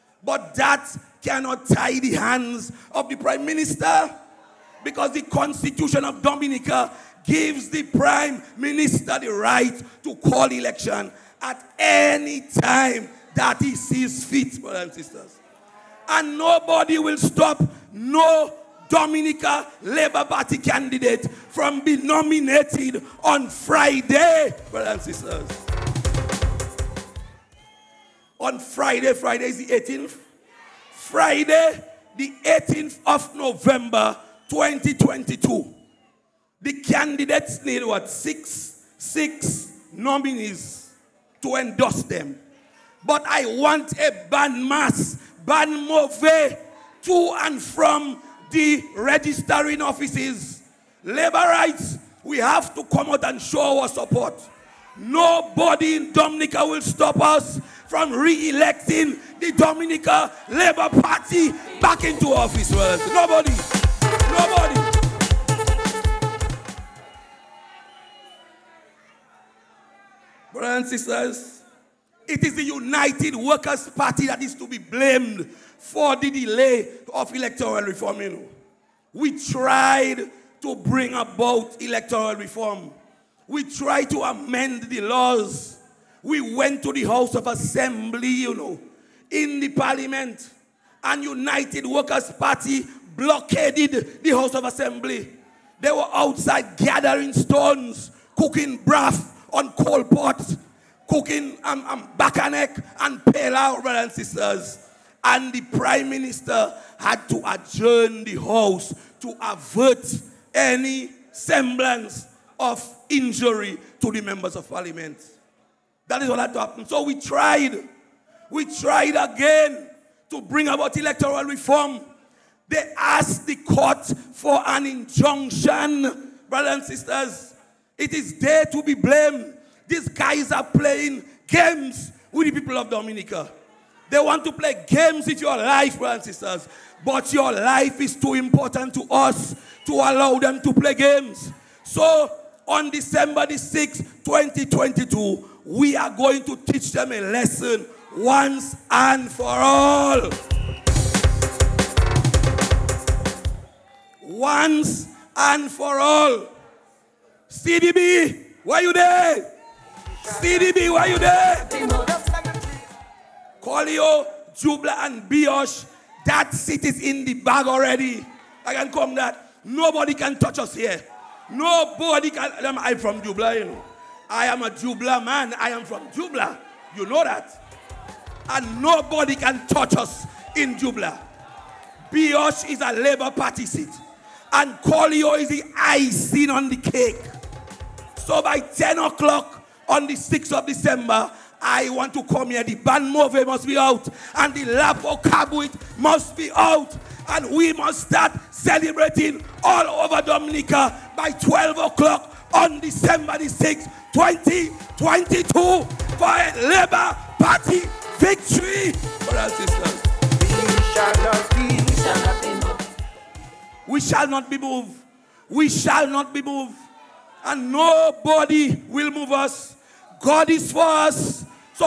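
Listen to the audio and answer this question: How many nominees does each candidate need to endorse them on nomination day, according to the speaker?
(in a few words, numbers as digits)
6.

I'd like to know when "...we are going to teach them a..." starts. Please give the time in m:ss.
2:25.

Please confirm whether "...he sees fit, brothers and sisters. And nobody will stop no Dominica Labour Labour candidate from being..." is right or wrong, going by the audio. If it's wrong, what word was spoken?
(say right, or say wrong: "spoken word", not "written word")
wrong: "Party", not "Labour".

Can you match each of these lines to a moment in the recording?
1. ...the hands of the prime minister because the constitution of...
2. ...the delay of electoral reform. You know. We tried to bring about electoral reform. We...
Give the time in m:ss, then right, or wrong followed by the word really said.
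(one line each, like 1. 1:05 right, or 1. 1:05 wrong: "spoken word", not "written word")
1. 0:01 right
2. 1:16 right.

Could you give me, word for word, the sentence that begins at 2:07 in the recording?
It is there to be blamed.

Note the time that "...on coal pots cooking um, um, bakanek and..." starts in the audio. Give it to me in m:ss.
1:39.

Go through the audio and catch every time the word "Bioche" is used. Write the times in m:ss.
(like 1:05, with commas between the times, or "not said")
2:45, 3:02.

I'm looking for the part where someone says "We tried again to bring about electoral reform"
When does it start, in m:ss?
1:58.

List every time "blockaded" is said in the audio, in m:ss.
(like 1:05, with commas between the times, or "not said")
1:33.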